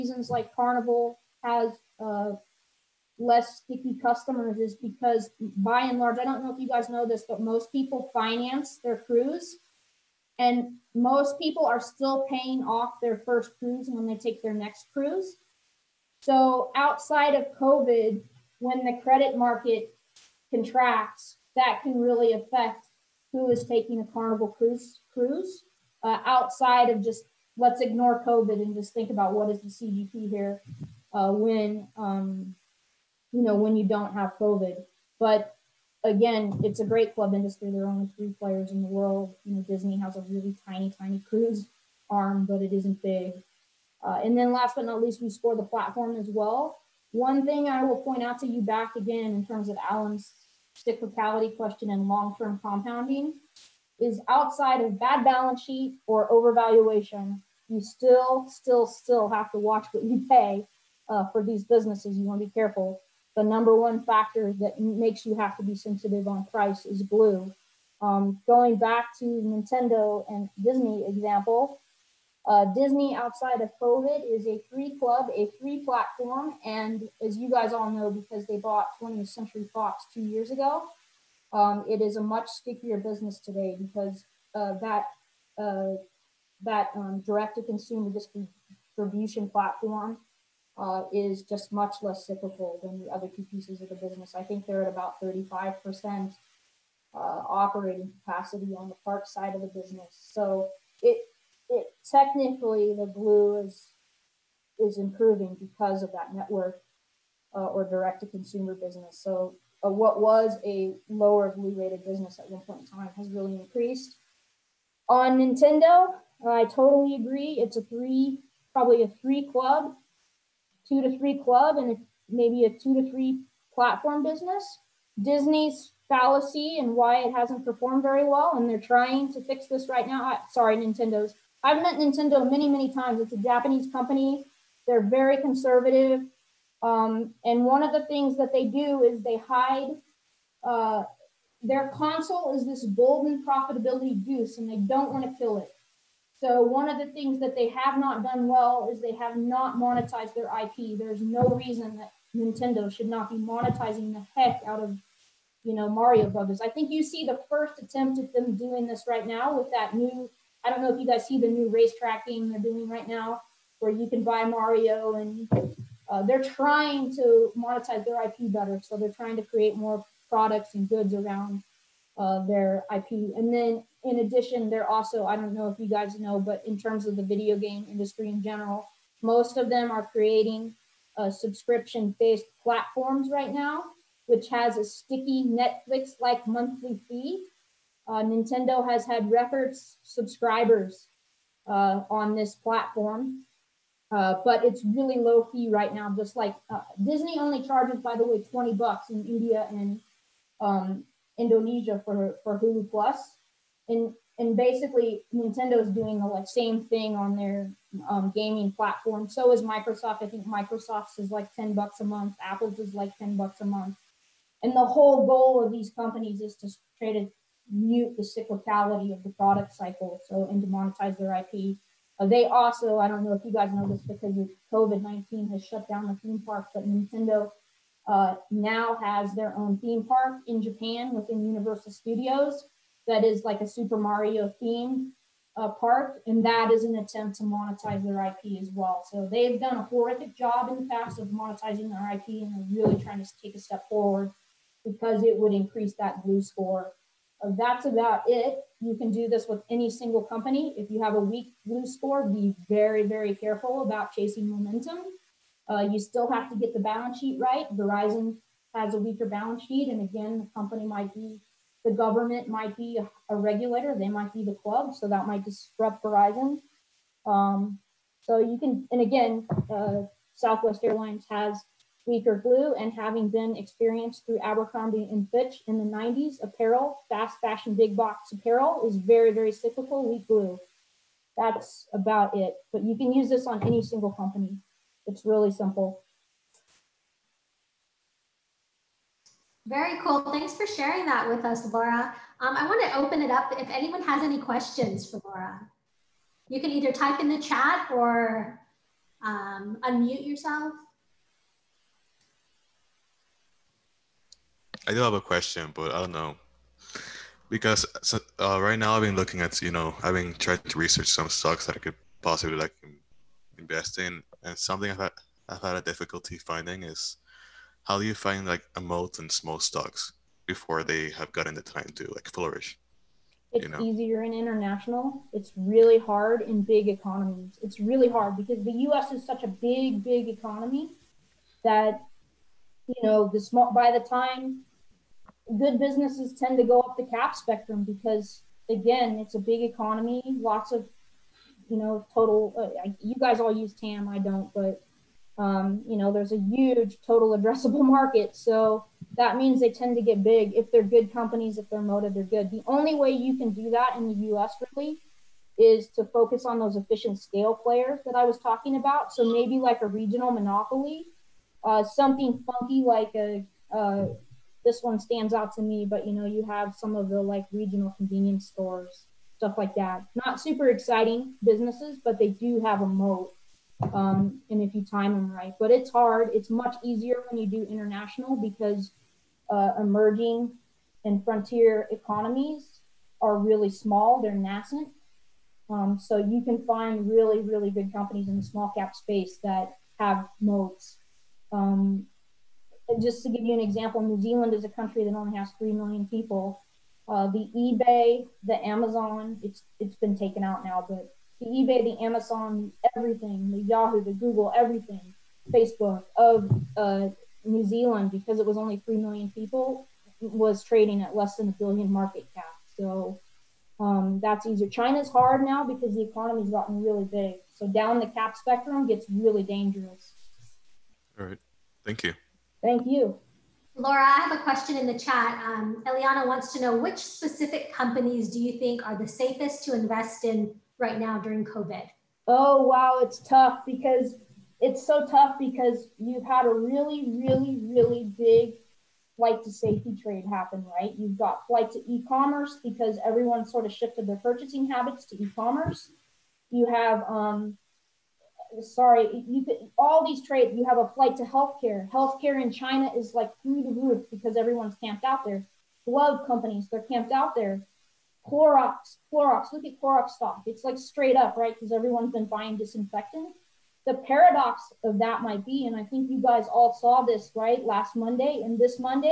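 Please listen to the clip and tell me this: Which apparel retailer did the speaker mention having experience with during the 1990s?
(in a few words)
Abercrombie and Fitch.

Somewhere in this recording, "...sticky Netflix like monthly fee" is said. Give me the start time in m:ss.
3:04.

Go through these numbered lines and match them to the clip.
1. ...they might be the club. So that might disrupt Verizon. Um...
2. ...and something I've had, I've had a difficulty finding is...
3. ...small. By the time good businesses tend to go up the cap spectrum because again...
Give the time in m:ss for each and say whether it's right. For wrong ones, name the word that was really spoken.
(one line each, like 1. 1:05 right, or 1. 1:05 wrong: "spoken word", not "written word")
1. 4:23 right
2. 5:14 right
3. 5:33 right.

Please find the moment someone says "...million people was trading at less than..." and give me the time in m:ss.
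6:48.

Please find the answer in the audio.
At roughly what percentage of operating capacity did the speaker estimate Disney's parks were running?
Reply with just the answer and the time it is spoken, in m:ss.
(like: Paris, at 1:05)
35%, at 1:35.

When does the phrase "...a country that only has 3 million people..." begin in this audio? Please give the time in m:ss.
6:34.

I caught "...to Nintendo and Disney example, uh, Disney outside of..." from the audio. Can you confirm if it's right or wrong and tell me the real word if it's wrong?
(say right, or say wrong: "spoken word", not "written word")
right.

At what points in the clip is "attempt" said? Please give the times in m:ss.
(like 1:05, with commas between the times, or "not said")
2:37, 3:56.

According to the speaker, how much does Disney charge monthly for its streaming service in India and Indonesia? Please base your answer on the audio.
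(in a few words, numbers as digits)
20 bucks.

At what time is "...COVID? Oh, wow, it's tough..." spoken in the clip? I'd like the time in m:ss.
7:11.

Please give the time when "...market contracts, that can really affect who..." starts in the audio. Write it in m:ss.
0:19.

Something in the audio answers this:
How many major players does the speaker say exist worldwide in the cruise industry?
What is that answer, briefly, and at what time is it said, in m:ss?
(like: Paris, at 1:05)
3, at 0:37.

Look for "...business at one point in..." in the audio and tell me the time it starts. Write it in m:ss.
1:52.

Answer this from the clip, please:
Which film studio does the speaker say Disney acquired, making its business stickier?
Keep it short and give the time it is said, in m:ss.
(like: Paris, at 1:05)
20th Century Fox, at 1:18.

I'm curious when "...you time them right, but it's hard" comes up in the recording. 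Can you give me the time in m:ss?
6:14.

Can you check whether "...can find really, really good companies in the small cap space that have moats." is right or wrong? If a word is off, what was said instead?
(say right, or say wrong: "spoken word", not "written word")
right.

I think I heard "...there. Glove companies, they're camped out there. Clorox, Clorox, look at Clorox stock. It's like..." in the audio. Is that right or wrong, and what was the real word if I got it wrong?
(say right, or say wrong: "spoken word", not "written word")
right.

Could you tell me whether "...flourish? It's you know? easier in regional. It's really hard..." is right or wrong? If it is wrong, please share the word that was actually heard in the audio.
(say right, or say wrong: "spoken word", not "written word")
wrong: "international", not "regional".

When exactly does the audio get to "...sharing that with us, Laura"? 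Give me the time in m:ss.
4:50.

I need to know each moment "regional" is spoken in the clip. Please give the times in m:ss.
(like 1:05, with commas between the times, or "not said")
5:59, 6:07.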